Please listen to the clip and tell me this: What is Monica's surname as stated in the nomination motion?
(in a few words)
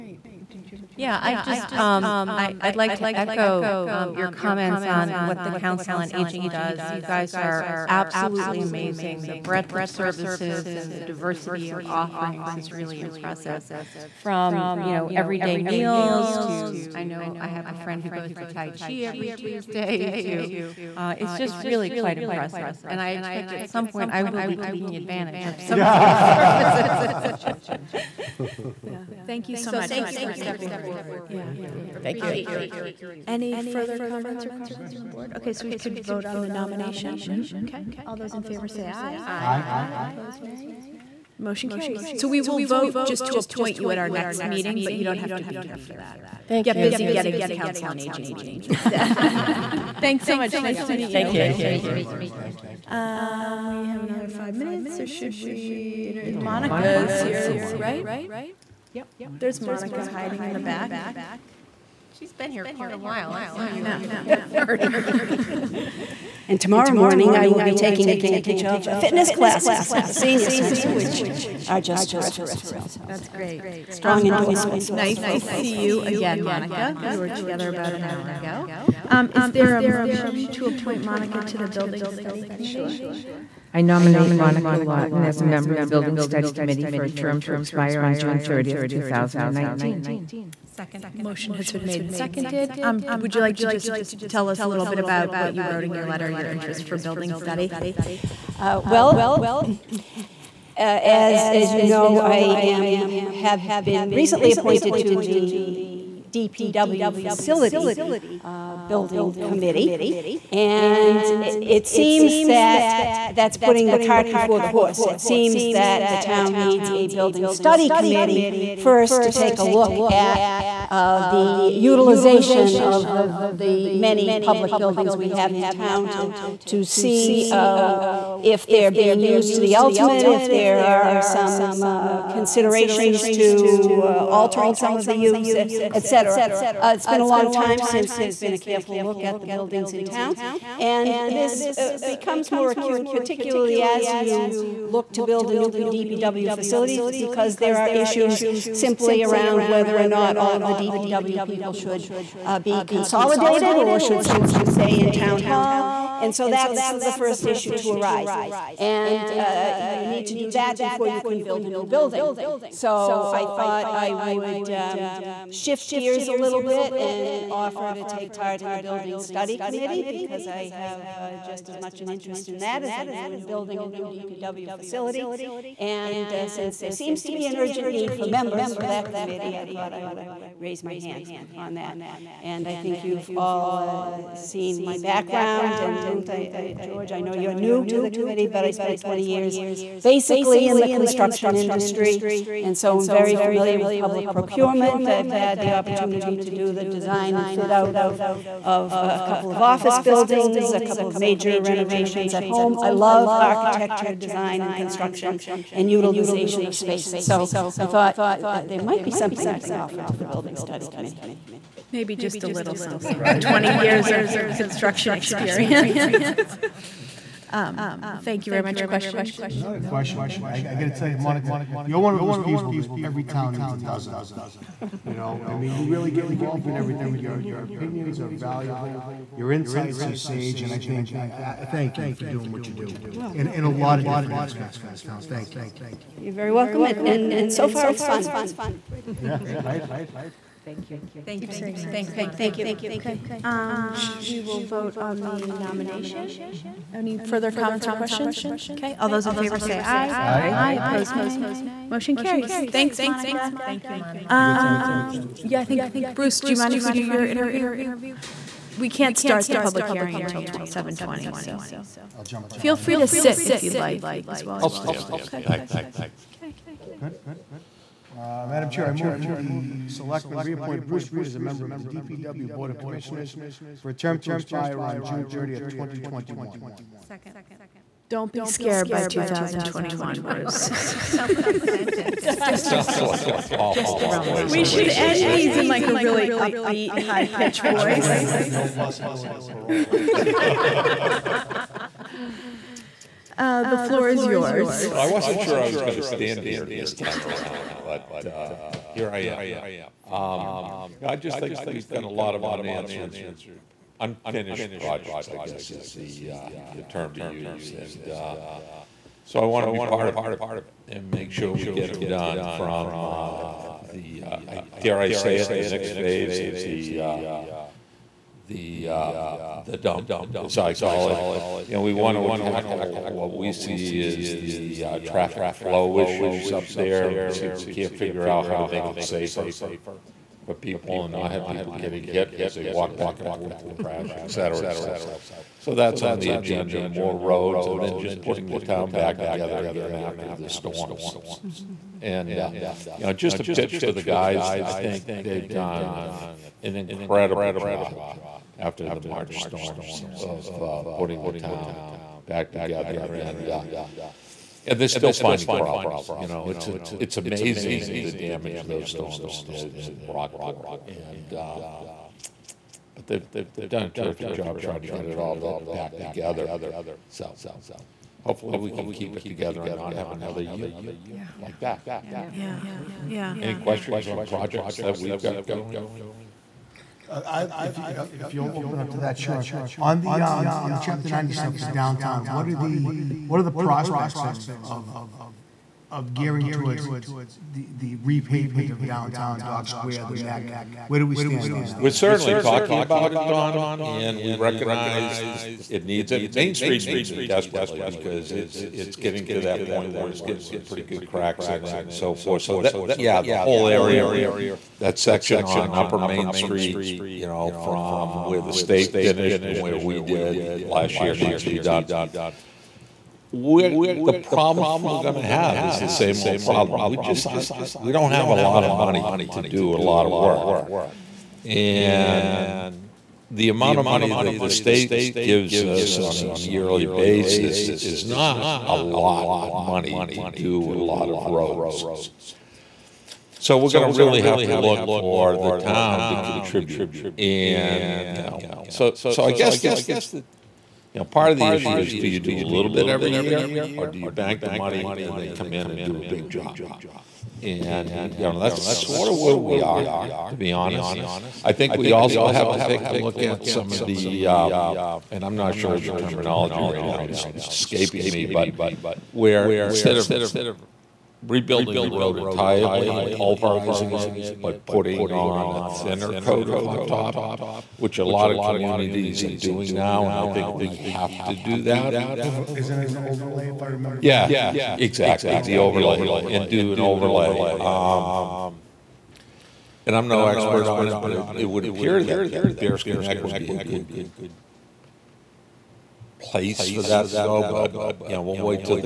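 Lawton.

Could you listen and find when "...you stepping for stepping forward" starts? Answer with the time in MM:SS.
00:30.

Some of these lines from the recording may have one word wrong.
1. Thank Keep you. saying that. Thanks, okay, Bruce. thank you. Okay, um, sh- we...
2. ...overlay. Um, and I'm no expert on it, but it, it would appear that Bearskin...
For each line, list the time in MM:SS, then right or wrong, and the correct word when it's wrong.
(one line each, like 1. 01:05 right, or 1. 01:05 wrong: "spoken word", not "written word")
1. 04:01 wrong: "Monica", not "Bruce"
2. 07:56 right.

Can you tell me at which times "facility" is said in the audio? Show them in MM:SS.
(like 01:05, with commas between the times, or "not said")
01:47, 02:26, 02:54.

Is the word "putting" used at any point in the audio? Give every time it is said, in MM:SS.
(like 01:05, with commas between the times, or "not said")
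01:53, 05:38, 05:50, 07:44.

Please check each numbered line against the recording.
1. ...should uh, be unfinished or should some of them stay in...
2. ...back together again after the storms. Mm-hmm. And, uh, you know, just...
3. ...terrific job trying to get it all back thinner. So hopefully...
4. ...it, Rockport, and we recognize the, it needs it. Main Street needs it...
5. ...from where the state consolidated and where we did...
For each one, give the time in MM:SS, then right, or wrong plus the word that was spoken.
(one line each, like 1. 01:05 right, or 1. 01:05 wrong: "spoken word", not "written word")
1. 02:31 wrong: "consolidated", not "unfinished"
2. 05:38 right
3. 06:03 wrong: "together", not "thinner"
4. 06:33 wrong: "Don", not "Rockport"
5. 06:47 wrong: "finished", not "consolidated".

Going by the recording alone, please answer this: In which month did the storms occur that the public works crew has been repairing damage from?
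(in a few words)
March.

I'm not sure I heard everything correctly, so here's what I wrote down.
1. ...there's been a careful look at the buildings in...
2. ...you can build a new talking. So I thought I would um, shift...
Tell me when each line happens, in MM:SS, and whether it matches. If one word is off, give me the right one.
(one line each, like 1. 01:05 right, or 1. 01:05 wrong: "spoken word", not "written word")
1. 02:18 right
2. 02:41 wrong: "building", not "talking".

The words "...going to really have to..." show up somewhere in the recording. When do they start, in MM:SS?
07:13.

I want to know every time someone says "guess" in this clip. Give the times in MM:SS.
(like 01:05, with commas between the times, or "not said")
05:05, 07:19.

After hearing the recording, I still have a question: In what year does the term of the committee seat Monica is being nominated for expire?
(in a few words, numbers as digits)
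2019.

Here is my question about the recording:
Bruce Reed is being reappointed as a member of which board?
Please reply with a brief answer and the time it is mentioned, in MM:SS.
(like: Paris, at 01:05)
DPW Board of Commissioners, at 04:31.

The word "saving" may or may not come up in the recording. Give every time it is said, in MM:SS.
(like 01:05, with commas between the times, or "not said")
not said.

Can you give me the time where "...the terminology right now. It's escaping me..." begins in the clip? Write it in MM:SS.
07:35.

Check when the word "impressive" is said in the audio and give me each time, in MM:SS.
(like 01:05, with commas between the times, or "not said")
00:13, 00:22.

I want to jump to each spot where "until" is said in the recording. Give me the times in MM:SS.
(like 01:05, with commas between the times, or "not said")
04:20.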